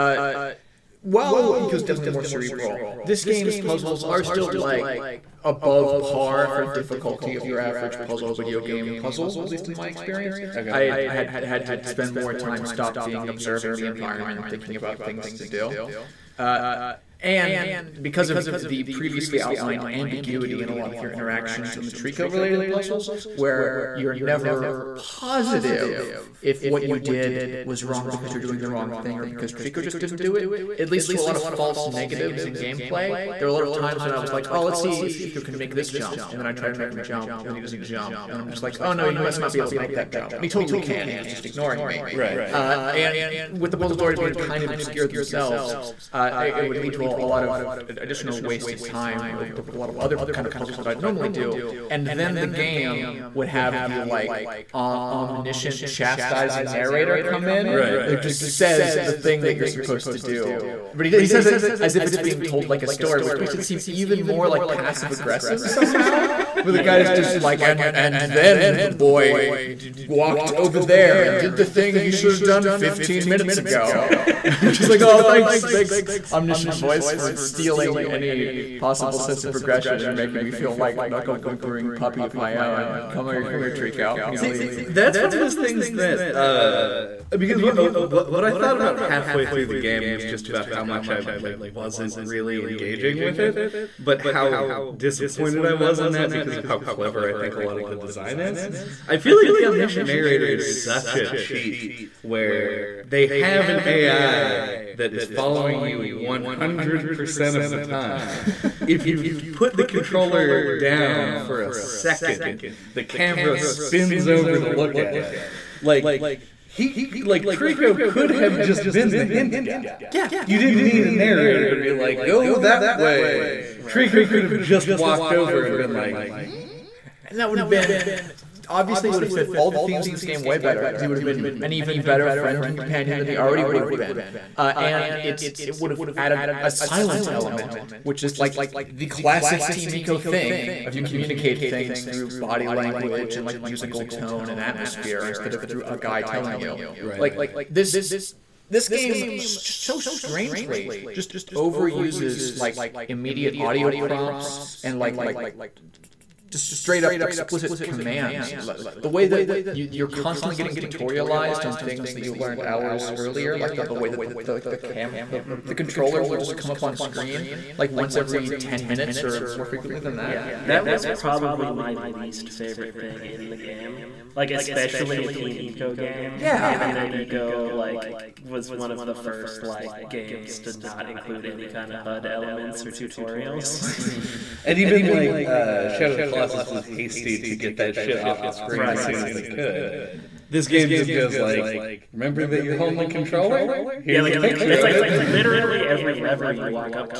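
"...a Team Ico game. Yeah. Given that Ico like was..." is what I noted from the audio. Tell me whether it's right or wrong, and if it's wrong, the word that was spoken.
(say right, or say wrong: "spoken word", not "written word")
right.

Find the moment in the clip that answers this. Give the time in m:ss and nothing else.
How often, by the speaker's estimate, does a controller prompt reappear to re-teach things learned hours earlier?
2:47.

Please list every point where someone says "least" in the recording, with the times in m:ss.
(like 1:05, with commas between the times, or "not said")
0:09, 2:51.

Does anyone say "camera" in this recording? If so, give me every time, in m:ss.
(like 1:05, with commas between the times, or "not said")
1:53.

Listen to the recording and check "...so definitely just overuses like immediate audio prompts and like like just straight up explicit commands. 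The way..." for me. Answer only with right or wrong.
wrong.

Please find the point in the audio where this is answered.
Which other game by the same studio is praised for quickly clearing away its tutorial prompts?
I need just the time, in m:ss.
3:05.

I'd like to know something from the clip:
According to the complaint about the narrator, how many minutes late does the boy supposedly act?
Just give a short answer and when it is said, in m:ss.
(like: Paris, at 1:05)
15, at 1:12.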